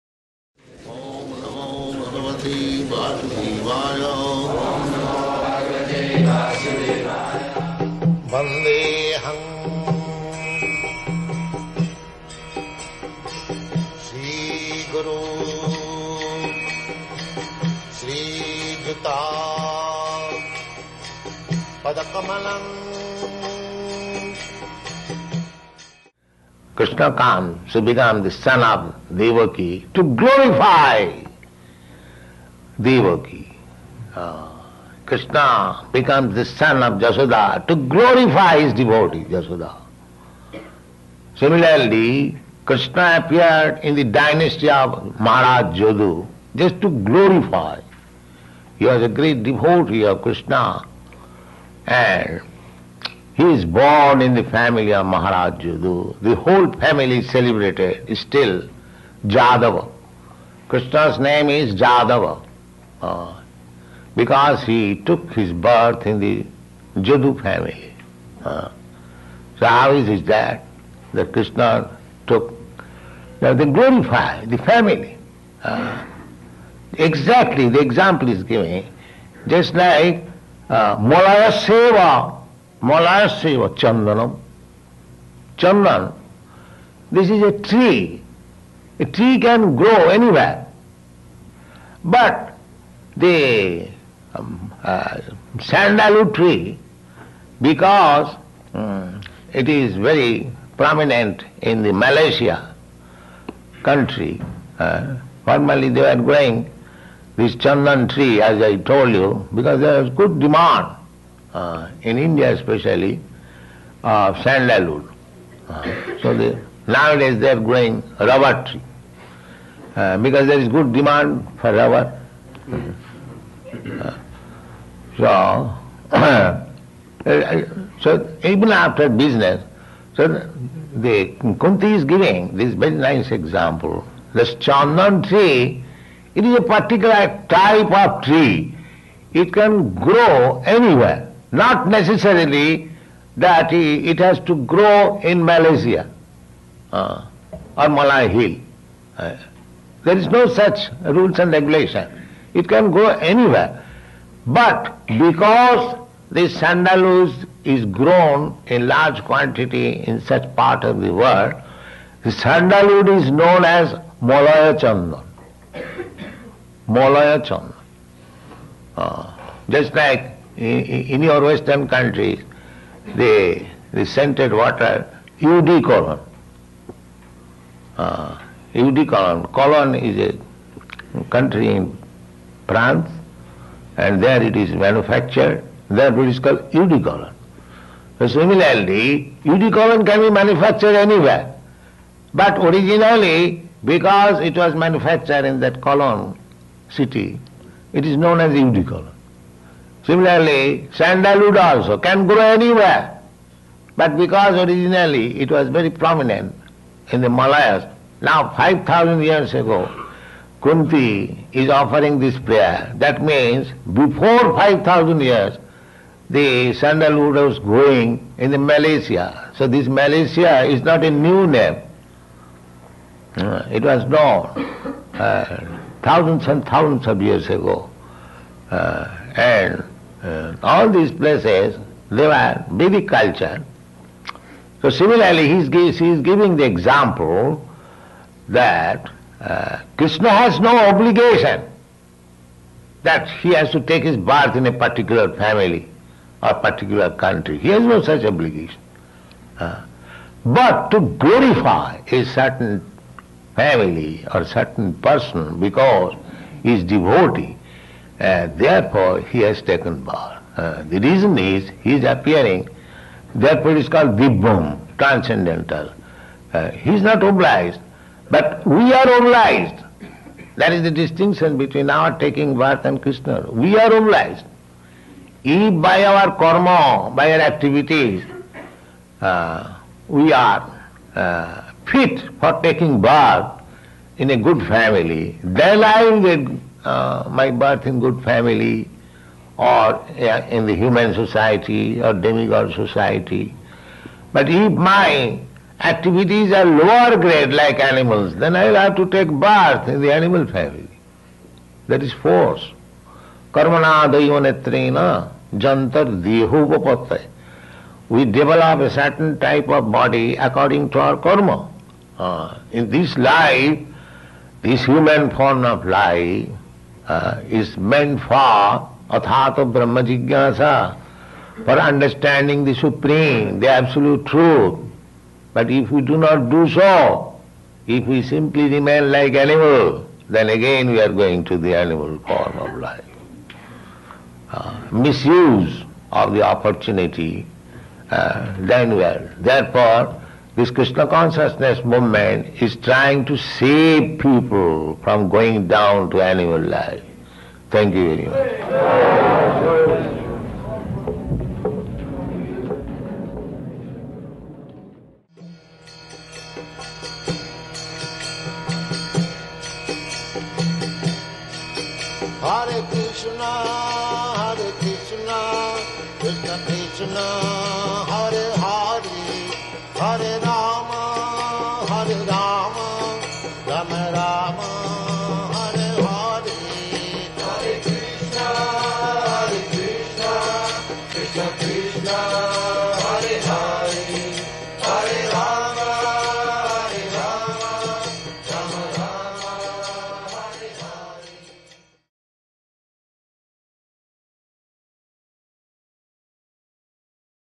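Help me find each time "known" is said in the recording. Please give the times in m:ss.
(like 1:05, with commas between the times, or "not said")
2:43, 3:18, 3:44.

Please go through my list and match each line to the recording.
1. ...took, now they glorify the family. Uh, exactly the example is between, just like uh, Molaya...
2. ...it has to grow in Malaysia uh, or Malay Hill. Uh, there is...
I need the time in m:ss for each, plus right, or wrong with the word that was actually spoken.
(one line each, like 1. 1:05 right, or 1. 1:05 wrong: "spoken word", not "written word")
1. 1:12 wrong: "given", not "between"
2. 2:23 right.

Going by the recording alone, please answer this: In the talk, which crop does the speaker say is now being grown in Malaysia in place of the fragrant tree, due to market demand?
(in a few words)
rubber tree.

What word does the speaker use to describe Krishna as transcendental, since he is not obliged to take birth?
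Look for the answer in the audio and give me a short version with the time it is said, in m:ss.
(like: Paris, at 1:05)
Vibhum, at 4:24.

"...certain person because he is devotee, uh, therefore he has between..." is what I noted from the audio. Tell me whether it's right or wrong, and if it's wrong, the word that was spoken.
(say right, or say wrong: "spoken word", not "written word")
wrong: "taken", not "between".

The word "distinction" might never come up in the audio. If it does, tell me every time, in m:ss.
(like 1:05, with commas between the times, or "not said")
4:30.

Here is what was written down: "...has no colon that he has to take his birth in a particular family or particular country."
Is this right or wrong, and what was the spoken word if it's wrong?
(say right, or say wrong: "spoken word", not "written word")
wrong: "obligation", not "colon".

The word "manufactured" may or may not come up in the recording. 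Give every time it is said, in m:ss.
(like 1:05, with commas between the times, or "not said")
3:04, 3:10, 3:14.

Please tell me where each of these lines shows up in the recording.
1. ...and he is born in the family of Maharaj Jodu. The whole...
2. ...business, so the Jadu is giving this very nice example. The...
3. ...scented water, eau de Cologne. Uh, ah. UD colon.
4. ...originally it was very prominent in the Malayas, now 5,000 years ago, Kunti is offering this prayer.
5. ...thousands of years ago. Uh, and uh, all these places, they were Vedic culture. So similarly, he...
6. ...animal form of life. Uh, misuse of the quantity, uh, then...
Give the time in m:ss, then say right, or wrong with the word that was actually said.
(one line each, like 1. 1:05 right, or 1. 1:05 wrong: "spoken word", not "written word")
1. 0:51 right
2. 2:09 wrong: "Kunti", not "Jadu"
3. 2:54 right
4. 3:24 right
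5. 3:46 right
6. 5:31 wrong: "opportunity", not "quantity".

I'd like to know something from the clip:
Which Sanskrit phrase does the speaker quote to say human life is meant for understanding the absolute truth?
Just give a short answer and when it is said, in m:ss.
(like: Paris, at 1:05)
athata brahma jigyasa, at 5:19.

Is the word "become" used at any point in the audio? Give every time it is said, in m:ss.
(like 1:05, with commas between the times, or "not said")
0:27, 0:35.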